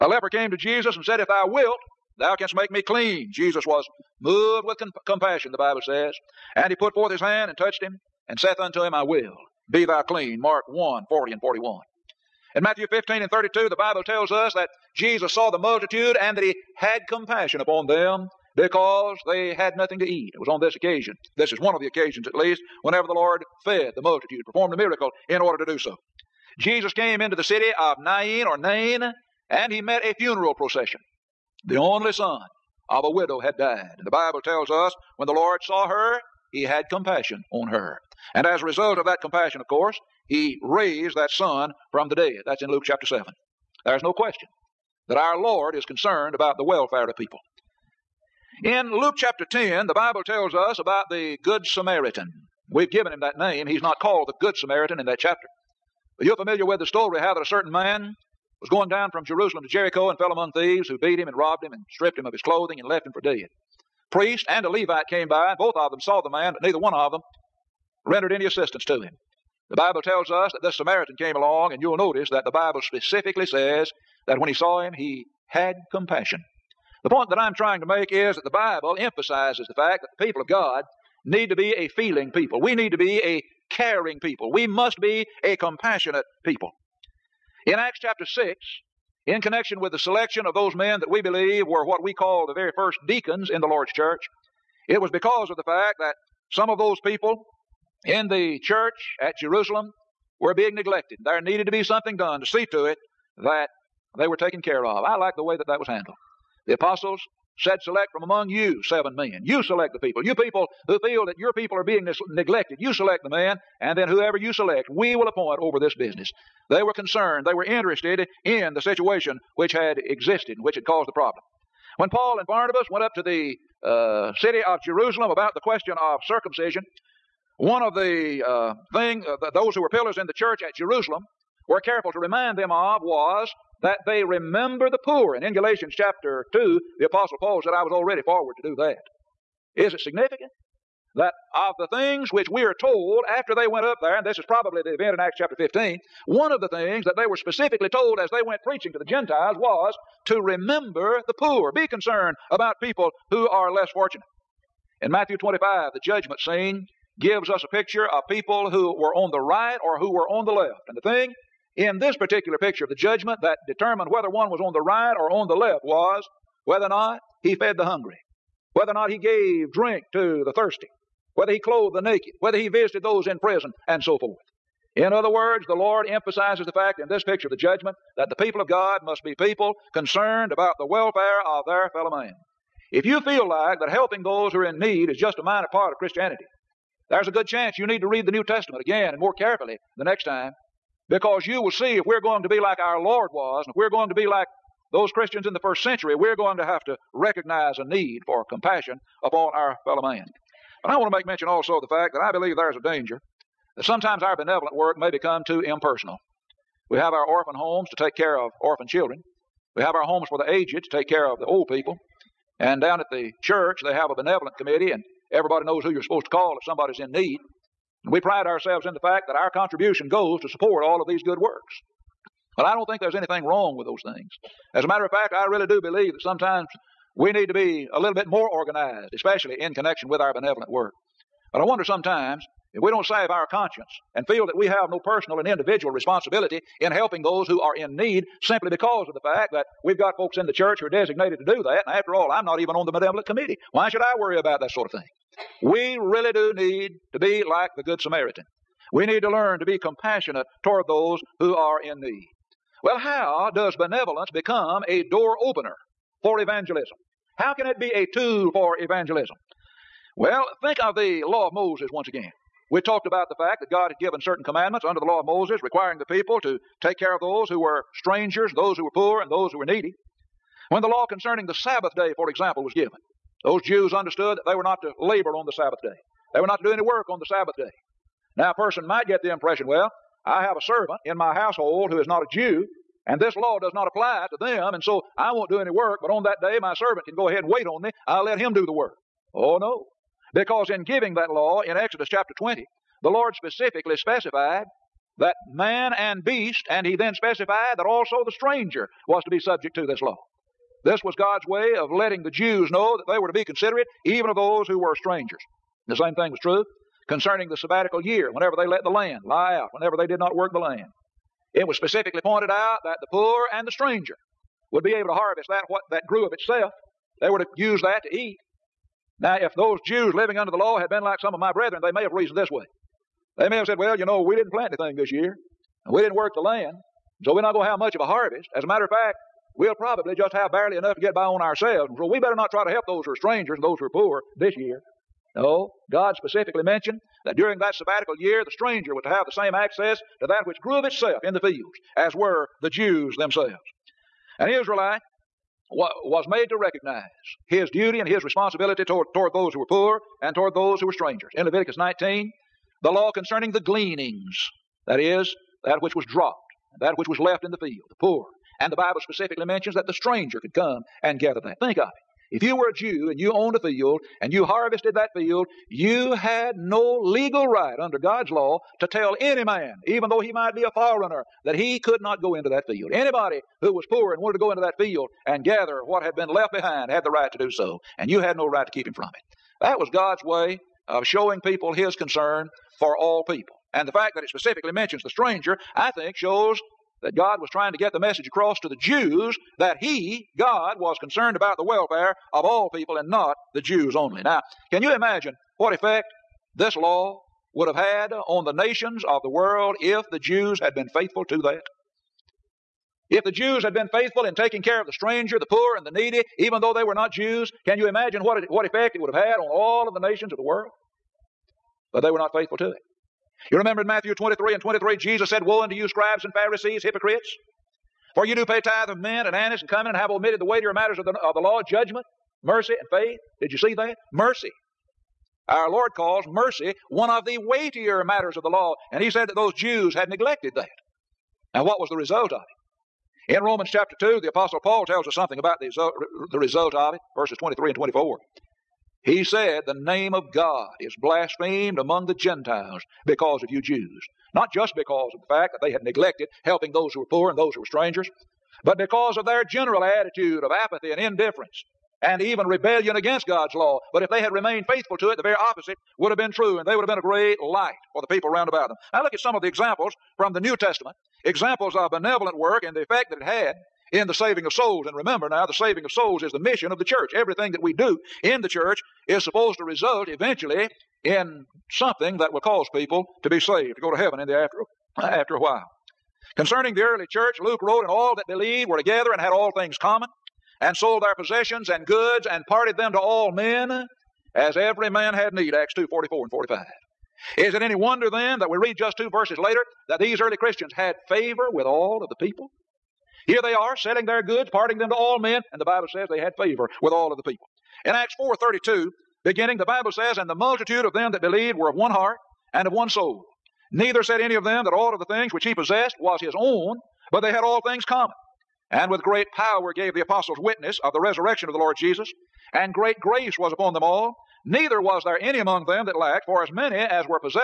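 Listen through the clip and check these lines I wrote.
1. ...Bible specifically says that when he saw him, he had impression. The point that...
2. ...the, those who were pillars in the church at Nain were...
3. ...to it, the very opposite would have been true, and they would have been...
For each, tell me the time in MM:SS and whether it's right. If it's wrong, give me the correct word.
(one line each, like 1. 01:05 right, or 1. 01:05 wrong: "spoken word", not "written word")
1. 01:12 wrong: "compassion", not "impression"
2. 02:09 wrong: "Jerusalem", not "Nain"
3. 07:34 right.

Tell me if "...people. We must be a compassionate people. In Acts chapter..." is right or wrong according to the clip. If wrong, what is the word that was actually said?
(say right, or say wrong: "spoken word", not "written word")
right.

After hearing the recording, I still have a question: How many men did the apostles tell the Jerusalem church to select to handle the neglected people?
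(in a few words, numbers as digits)
7.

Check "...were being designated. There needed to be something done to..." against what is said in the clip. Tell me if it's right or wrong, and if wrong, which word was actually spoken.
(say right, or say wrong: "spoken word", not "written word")
wrong: "neglected", not "designated".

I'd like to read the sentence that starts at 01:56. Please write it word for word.
They were concerned, they were interested in the situation which had existed and which had caused the problem.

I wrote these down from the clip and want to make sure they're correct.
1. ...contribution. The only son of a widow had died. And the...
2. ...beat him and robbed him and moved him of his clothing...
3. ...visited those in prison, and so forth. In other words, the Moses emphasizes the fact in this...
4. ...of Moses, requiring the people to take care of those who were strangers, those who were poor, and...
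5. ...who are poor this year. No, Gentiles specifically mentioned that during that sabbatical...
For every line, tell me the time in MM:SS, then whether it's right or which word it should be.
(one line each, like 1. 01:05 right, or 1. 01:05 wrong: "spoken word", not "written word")
1. 00:30 wrong: "procession", not "contribution"
2. 01:00 wrong: "stripped", not "moved"
3. 02:52 wrong: "Lord", not "Moses"
4. 04:25 right
5. 05:33 wrong: "God", not "Gentiles".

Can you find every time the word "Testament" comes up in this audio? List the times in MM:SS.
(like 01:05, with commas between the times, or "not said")
03:08, 07:40.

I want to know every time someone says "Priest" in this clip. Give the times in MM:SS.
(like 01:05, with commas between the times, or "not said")
01:04.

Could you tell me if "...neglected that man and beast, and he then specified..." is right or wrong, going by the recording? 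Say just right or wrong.
wrong.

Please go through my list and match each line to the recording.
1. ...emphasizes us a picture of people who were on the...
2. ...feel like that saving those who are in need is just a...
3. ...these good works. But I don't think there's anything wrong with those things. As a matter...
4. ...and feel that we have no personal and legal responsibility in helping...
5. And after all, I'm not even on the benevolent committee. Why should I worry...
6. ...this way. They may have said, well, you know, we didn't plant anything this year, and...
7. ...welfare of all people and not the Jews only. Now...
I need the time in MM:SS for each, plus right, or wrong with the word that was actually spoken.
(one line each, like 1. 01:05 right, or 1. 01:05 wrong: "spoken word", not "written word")
1. 02:37 wrong: "gives", not "emphasizes"
2. 03:03 wrong: "helping", not "saving"
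3. 03:41 right
4. 03:54 wrong: "individual", not "legal"
5. 04:01 right
6. 05:22 right
7. 06:31 right.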